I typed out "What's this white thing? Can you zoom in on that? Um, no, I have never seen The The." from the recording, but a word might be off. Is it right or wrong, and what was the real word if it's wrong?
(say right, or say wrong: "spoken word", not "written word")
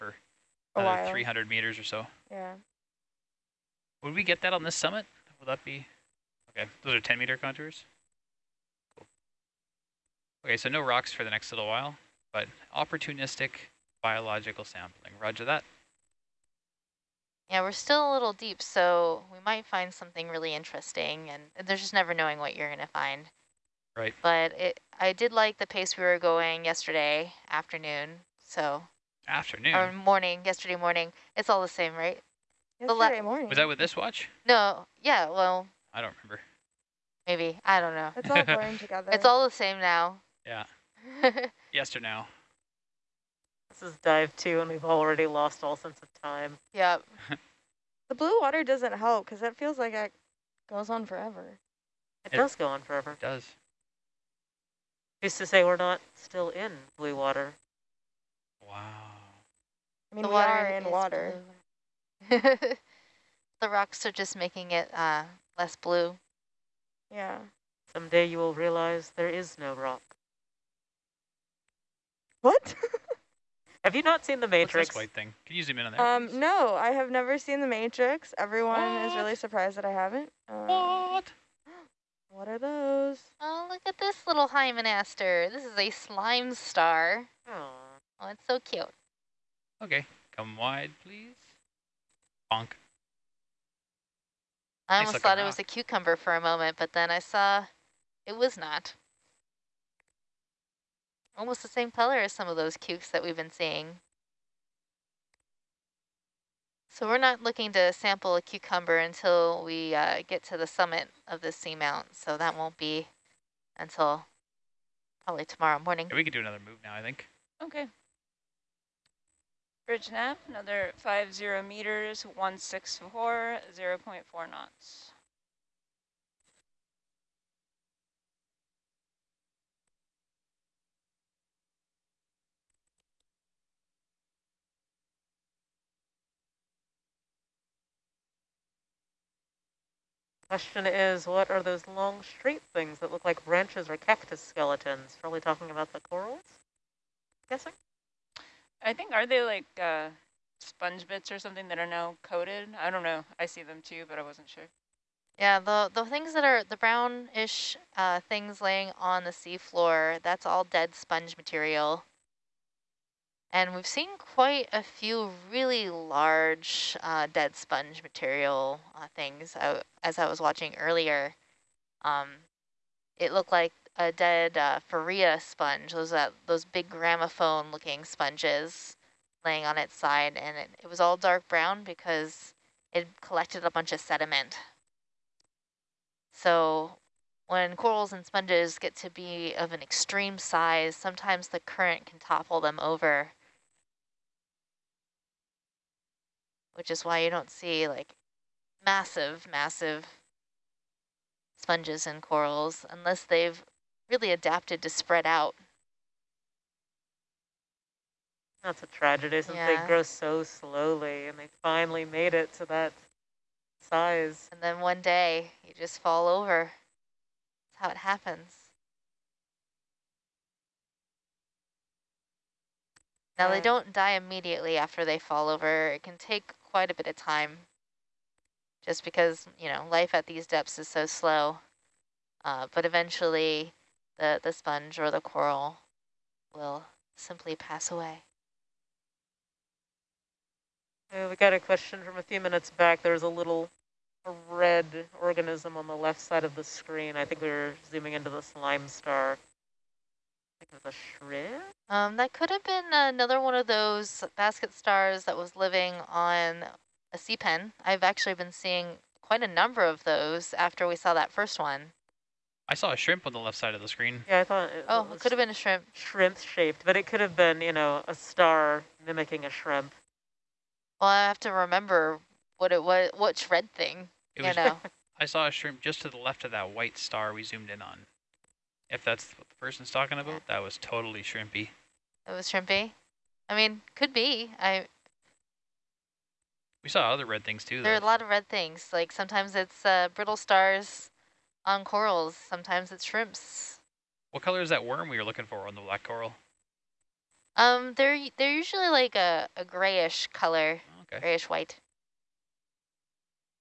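wrong: "Matrix", not "The".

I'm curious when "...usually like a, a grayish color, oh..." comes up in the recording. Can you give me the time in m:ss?
4:58.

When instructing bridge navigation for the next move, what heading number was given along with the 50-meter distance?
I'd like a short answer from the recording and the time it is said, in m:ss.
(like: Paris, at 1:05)
164, at 2:02.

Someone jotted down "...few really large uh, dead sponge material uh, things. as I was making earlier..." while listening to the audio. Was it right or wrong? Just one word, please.
wrong.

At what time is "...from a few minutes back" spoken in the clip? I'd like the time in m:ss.
4:02.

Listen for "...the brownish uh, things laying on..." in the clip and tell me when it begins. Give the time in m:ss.
2:36.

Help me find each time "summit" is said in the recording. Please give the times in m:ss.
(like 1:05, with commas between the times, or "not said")
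0:04, 1:50.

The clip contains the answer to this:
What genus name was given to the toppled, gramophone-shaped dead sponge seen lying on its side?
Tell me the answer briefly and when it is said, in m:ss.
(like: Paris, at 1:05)
Farrea, at 2:54.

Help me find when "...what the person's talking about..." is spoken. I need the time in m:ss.
4:39.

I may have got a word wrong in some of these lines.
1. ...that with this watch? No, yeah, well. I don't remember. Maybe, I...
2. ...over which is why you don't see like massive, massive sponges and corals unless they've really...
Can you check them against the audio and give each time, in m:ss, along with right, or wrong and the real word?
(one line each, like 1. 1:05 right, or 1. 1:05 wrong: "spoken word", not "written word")
1. 0:33 right
2. 3:12 right.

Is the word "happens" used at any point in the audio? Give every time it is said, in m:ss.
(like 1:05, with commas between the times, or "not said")
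3:37.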